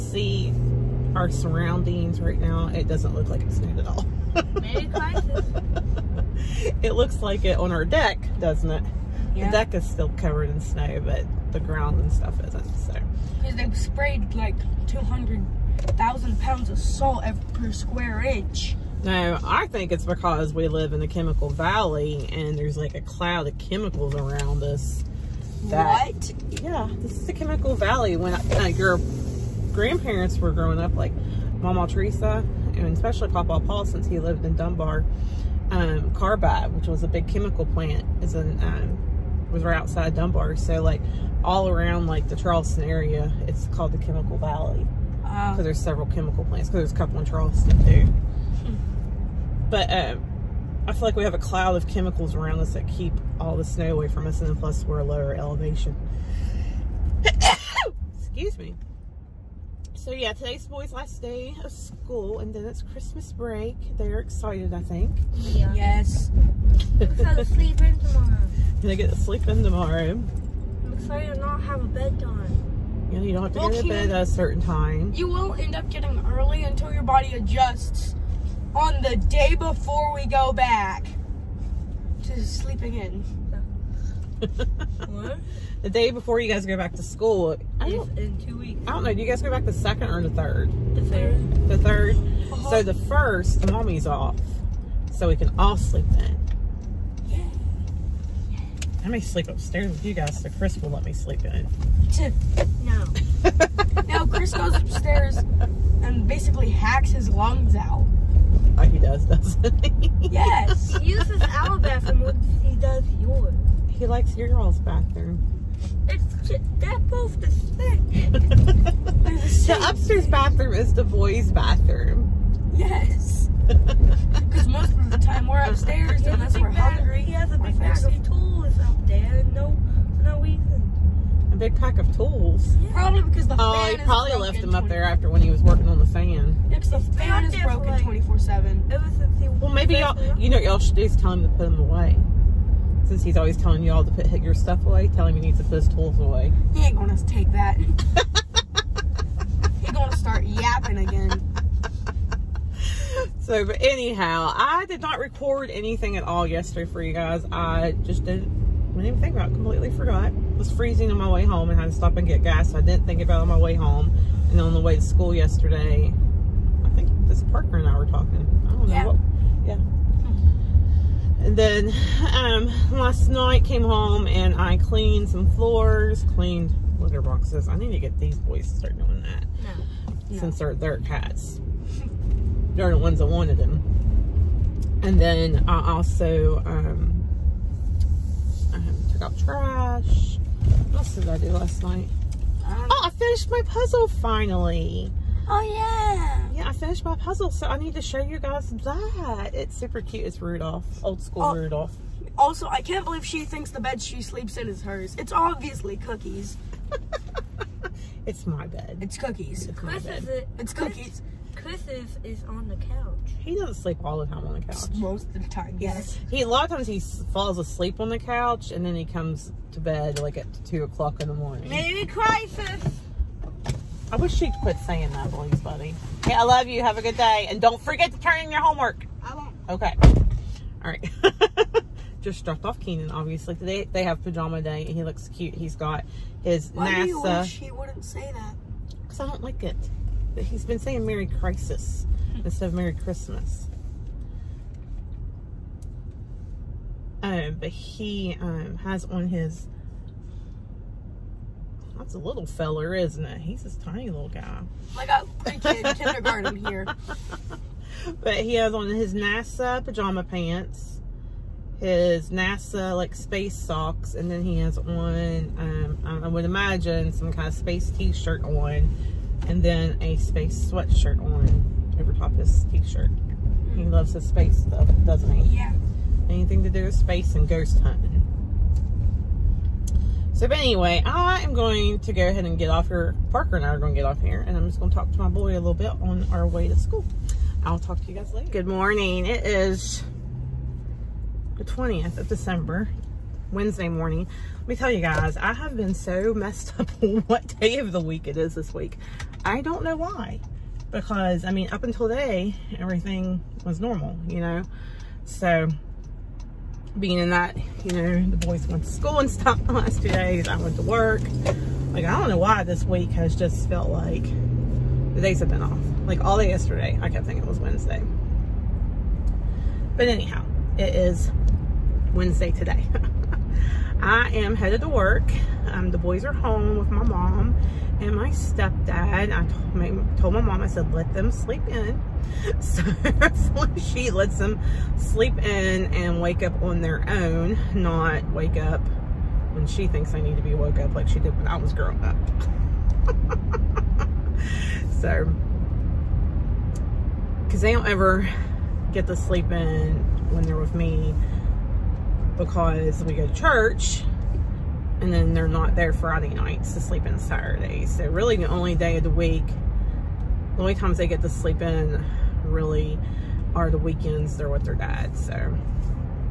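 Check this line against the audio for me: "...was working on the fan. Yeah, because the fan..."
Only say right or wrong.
right.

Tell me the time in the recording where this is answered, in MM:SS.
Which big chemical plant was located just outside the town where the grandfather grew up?
00:36.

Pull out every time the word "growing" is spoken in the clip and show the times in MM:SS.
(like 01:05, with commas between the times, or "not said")
00:30, 05:41.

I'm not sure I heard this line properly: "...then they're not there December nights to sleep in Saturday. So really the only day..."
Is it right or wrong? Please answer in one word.
wrong.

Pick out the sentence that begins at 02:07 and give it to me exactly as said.
He has a big pack of tools up there.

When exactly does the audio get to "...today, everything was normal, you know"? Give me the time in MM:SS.
05:02.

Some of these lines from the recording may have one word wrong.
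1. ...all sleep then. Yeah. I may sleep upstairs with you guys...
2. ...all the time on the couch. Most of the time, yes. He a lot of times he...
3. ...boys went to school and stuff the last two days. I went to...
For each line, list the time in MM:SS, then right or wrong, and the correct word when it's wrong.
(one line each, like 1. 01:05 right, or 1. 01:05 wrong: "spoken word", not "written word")
1. 01:35 right
2. 03:34 right
3. 05:08 right.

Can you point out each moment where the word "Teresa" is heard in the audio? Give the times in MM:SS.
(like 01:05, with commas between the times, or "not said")
00:31.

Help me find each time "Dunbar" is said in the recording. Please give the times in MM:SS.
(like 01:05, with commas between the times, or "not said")
00:34, 00:40.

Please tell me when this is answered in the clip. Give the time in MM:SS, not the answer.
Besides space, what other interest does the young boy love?
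04:37.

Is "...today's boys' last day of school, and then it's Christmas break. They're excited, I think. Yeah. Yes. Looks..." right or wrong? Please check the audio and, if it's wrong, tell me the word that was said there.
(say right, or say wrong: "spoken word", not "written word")
right.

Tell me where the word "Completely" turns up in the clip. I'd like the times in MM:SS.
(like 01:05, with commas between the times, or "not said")
02:39.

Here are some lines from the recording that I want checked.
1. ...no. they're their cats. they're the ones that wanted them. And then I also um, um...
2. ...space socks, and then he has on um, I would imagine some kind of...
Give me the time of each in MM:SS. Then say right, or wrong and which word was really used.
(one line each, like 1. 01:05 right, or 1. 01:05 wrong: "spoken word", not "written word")
1. 03:00 right
2. 04:23 right.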